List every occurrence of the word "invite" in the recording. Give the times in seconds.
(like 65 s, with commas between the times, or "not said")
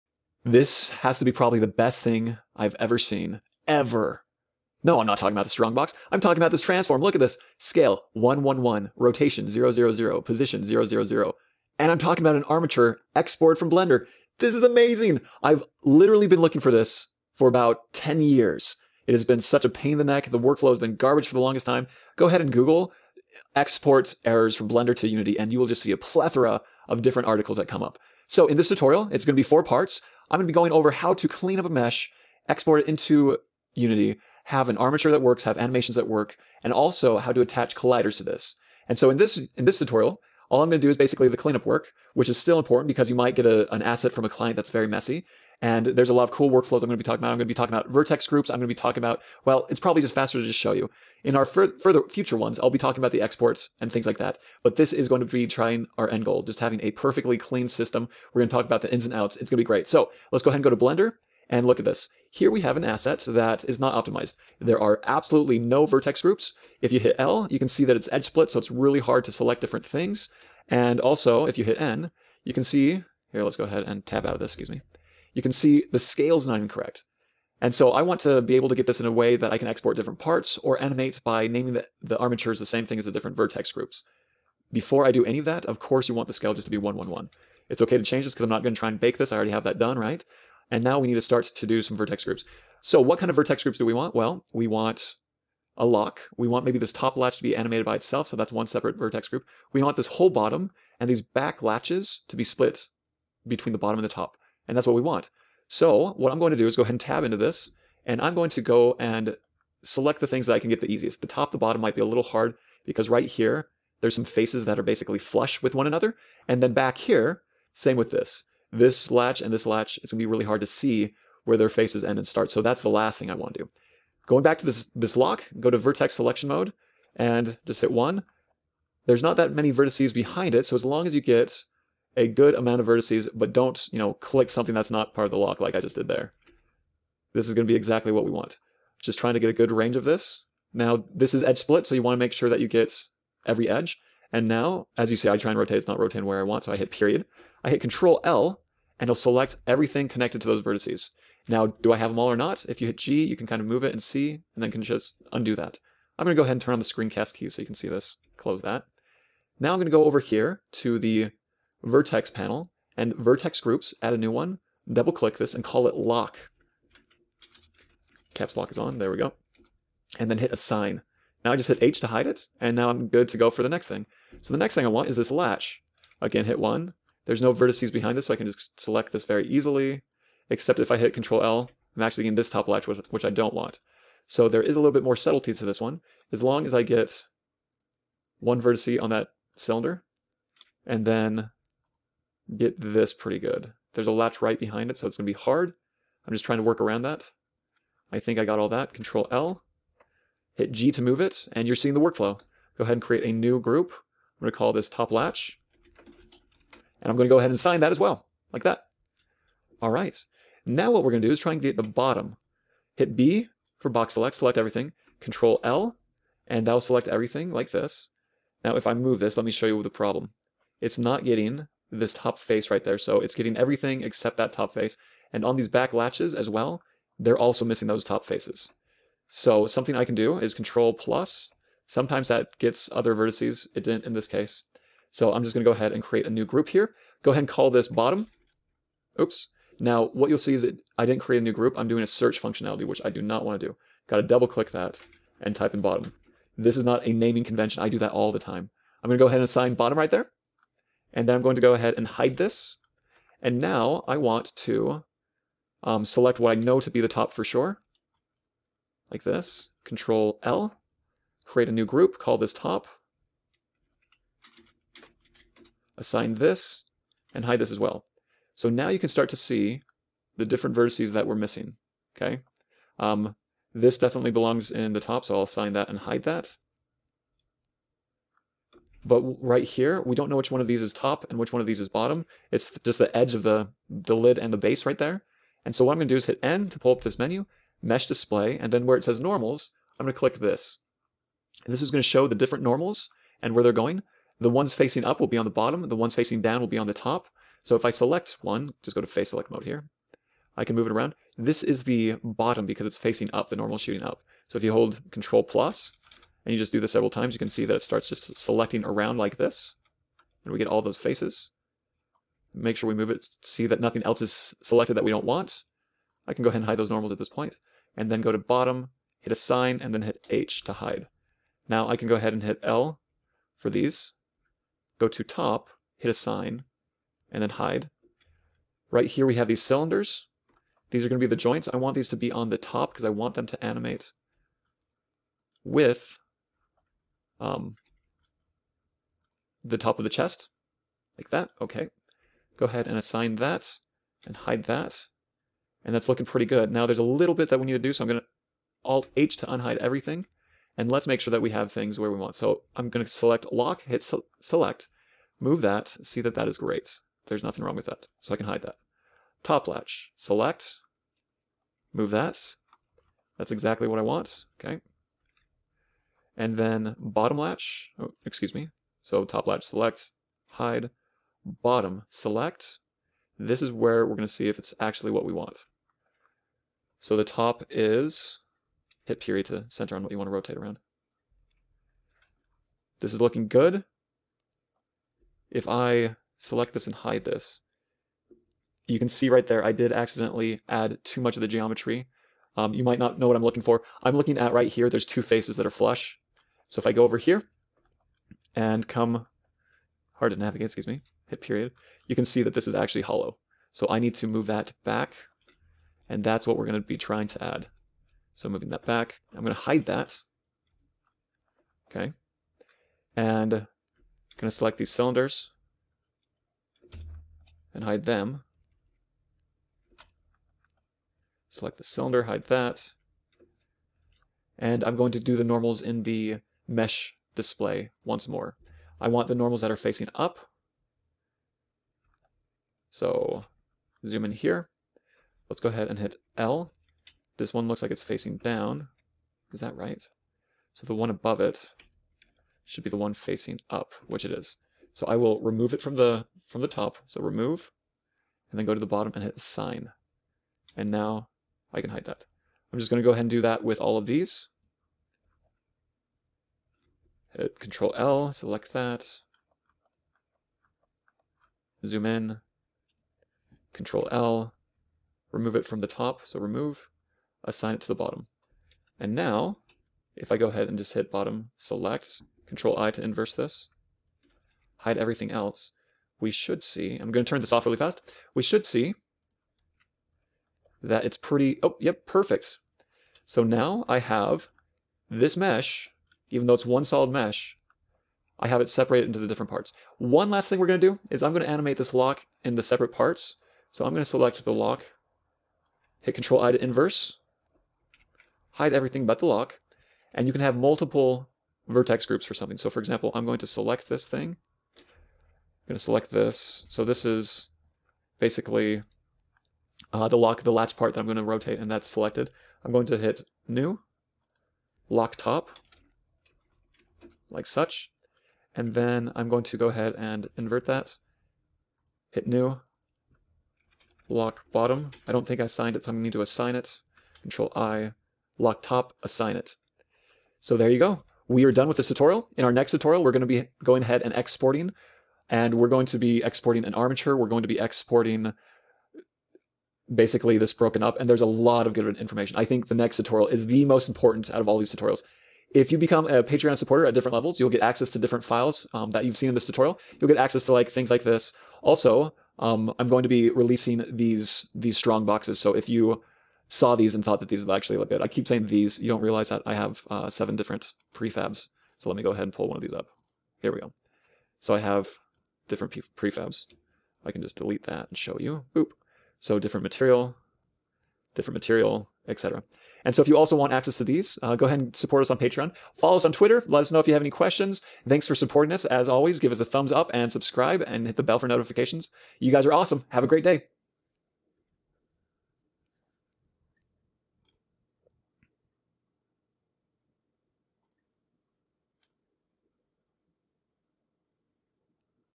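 not said.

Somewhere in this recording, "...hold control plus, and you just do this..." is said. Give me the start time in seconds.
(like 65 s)
304 s.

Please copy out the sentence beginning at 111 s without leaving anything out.
The top, the bottom might be a little hard because right here, there's some faces that are basically flush with one another.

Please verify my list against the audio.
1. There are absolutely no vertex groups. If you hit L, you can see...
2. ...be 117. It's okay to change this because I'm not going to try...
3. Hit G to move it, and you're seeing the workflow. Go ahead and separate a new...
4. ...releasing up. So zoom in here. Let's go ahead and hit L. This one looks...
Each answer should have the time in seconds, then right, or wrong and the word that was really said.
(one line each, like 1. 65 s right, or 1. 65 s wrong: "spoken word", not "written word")
1. 64 s right
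2. 86 s wrong: "111", not "117"
3. 200 s wrong: "create", not "separate"
4. 429 s wrong: "facing", not "releasing".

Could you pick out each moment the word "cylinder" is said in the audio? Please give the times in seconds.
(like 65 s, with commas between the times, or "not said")
189 s, 329 s, 414 s, 421 s.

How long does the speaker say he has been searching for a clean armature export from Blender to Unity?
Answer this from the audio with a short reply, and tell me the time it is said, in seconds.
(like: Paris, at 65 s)
about 10 years, at 17 s.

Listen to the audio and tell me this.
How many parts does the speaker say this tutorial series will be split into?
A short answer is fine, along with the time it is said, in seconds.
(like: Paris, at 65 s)
4, at 29 s.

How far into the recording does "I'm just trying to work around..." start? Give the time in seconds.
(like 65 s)
196 s.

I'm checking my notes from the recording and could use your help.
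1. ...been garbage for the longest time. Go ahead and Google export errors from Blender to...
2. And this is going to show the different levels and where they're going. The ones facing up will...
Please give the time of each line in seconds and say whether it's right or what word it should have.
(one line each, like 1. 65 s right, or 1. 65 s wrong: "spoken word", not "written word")
1. 20 s right
2. 291 s wrong: "normals", not "levels".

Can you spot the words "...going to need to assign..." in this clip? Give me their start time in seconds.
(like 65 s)
525 s.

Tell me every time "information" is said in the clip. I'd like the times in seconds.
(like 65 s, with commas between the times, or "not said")
541 s.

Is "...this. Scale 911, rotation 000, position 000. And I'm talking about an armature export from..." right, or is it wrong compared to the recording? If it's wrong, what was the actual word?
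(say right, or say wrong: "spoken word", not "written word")
wrong: "111", not "911".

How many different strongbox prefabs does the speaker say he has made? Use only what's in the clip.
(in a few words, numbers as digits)
7.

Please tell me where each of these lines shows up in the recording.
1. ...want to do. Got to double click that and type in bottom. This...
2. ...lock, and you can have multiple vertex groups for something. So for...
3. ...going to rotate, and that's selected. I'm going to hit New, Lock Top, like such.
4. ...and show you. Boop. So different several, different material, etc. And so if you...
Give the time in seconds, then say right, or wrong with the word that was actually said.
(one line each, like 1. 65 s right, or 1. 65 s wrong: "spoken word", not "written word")
1. 243 s right
2. 499 s right
3. 511 s right
4. 567 s wrong: "material", not "several".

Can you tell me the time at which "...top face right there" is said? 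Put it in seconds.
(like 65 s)
222 s.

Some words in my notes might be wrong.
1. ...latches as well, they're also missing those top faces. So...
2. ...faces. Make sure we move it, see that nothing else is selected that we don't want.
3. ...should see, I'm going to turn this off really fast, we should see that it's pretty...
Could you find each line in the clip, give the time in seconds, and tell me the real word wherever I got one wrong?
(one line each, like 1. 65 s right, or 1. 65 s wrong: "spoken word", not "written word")
1. 225 s right
2. 310 s right
3. 476 s right.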